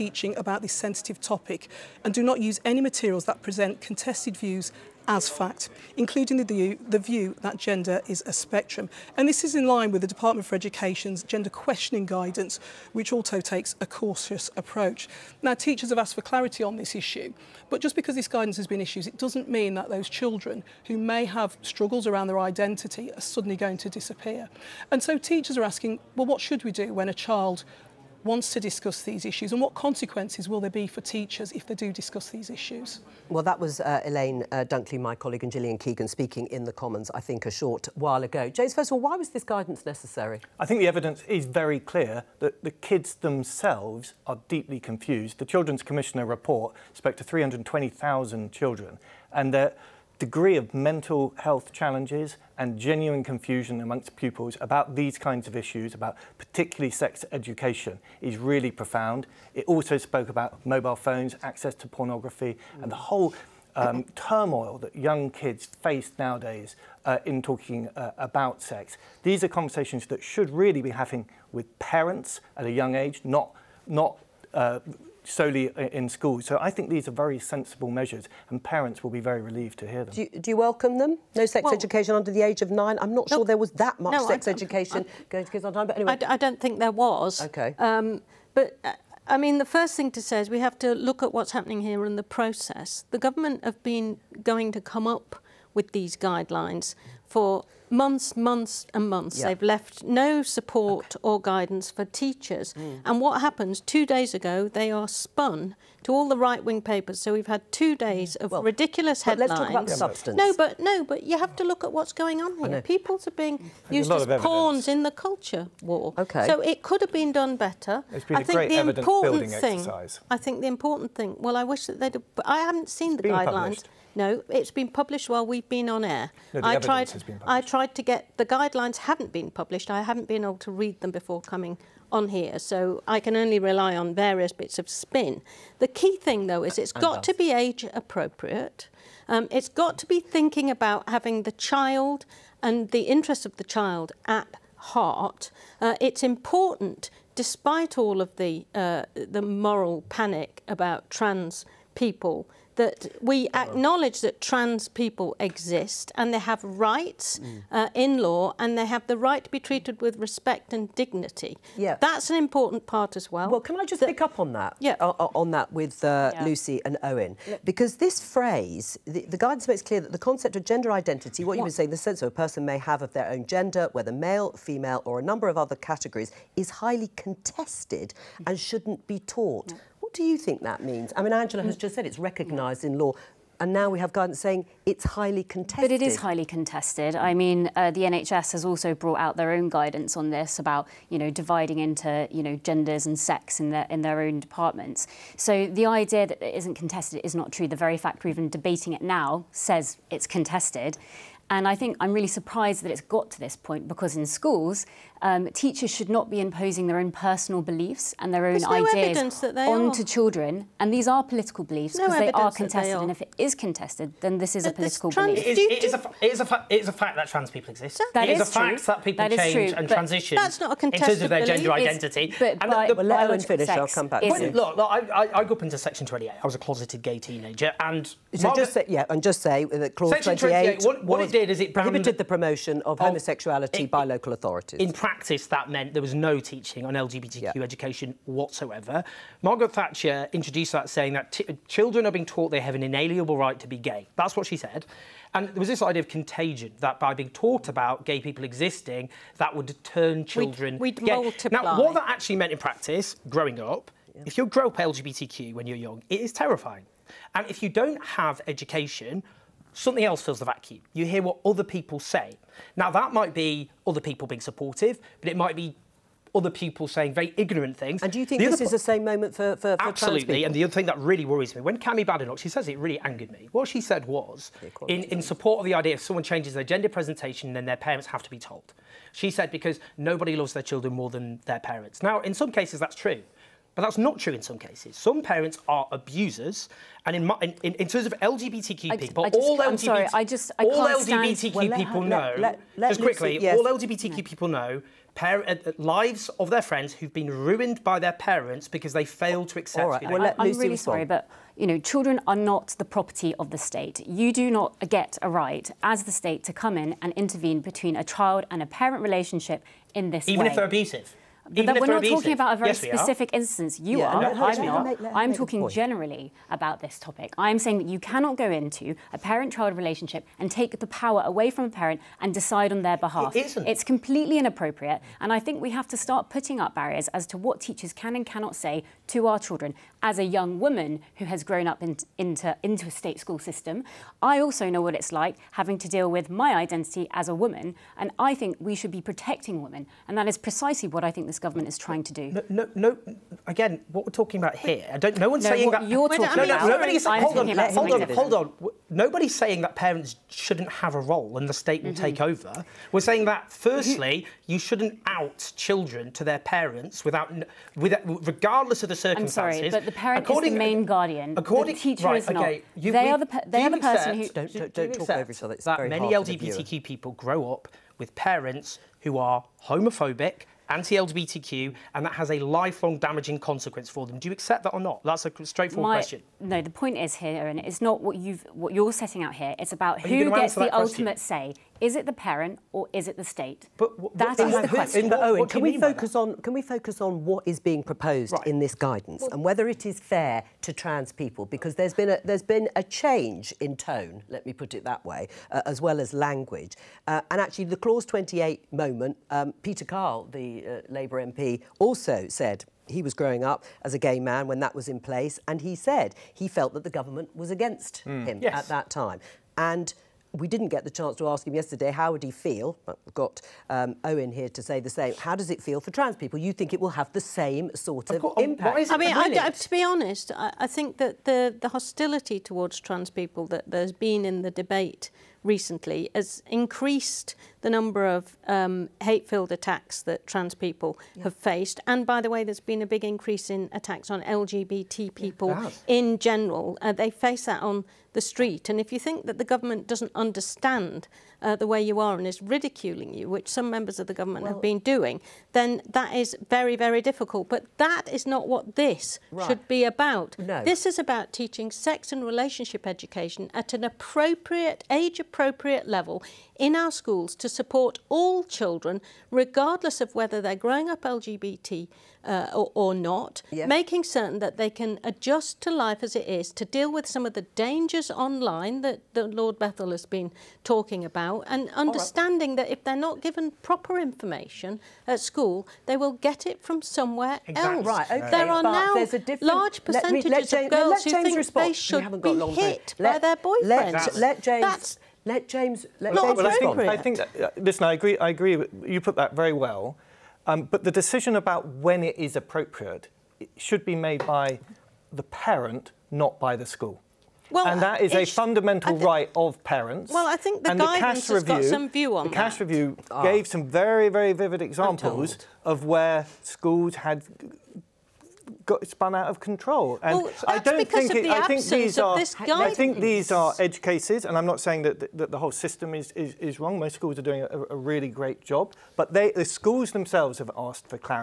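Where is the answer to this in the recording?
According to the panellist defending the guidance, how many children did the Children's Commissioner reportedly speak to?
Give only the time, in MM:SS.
00:47.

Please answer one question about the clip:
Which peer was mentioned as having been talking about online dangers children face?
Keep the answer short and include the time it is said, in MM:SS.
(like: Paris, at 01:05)
Lord Bethell, at 07:49.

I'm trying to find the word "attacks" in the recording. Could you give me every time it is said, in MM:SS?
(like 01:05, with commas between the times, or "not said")
07:09, 07:13.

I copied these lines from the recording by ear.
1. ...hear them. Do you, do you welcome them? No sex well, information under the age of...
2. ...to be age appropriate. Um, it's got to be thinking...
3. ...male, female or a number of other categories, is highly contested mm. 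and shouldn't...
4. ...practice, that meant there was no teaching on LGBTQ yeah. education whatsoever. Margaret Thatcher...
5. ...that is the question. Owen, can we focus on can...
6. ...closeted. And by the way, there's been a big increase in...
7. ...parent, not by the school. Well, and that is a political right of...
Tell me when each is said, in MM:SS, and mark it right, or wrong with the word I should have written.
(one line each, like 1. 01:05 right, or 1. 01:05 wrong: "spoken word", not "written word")
1. 01:19 wrong: "education", not "information"
2. 02:17 right
3. 02:54 right
4. 03:54 right
5. 06:24 right
6. 07:11 wrong: "faced", not "closeted"
7. 08:15 wrong: "fundamental", not "political".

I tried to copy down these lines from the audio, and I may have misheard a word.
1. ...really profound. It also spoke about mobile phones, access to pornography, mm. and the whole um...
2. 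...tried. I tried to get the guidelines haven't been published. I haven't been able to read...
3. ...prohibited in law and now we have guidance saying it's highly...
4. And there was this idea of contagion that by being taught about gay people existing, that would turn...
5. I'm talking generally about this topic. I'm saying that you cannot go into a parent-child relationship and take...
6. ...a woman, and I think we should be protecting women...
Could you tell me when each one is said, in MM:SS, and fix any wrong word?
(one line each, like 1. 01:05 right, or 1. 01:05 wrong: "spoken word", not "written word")
1. 00:58 right
2. 02:06 right
3. 03:02 wrong: "recognised", not "prohibited"
4. 04:05 right
5. 05:15 right
6. 05:37 right.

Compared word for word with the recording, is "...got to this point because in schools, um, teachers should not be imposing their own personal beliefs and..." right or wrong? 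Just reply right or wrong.
right.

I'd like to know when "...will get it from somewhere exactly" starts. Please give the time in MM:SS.
07:55.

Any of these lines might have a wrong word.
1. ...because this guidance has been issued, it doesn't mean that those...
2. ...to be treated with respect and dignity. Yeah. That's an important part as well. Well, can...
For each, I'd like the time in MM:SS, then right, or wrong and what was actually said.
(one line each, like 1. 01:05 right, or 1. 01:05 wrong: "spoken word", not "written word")
1. 00:17 right
2. 02:39 right.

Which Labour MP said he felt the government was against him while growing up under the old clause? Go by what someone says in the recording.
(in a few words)
Peter Kyle.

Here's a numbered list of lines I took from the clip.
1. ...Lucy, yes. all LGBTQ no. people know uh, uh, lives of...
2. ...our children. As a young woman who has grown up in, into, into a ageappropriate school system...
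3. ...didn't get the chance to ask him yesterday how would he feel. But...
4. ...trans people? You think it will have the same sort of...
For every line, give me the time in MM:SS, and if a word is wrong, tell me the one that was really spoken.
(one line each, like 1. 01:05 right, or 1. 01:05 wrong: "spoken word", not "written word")
1. 04:53 right
2. 05:29 wrong: "state", not "ageappropriate"
3. 06:50 right
4. 06:55 right.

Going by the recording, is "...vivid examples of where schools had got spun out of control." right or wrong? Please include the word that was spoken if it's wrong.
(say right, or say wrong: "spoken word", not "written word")
right.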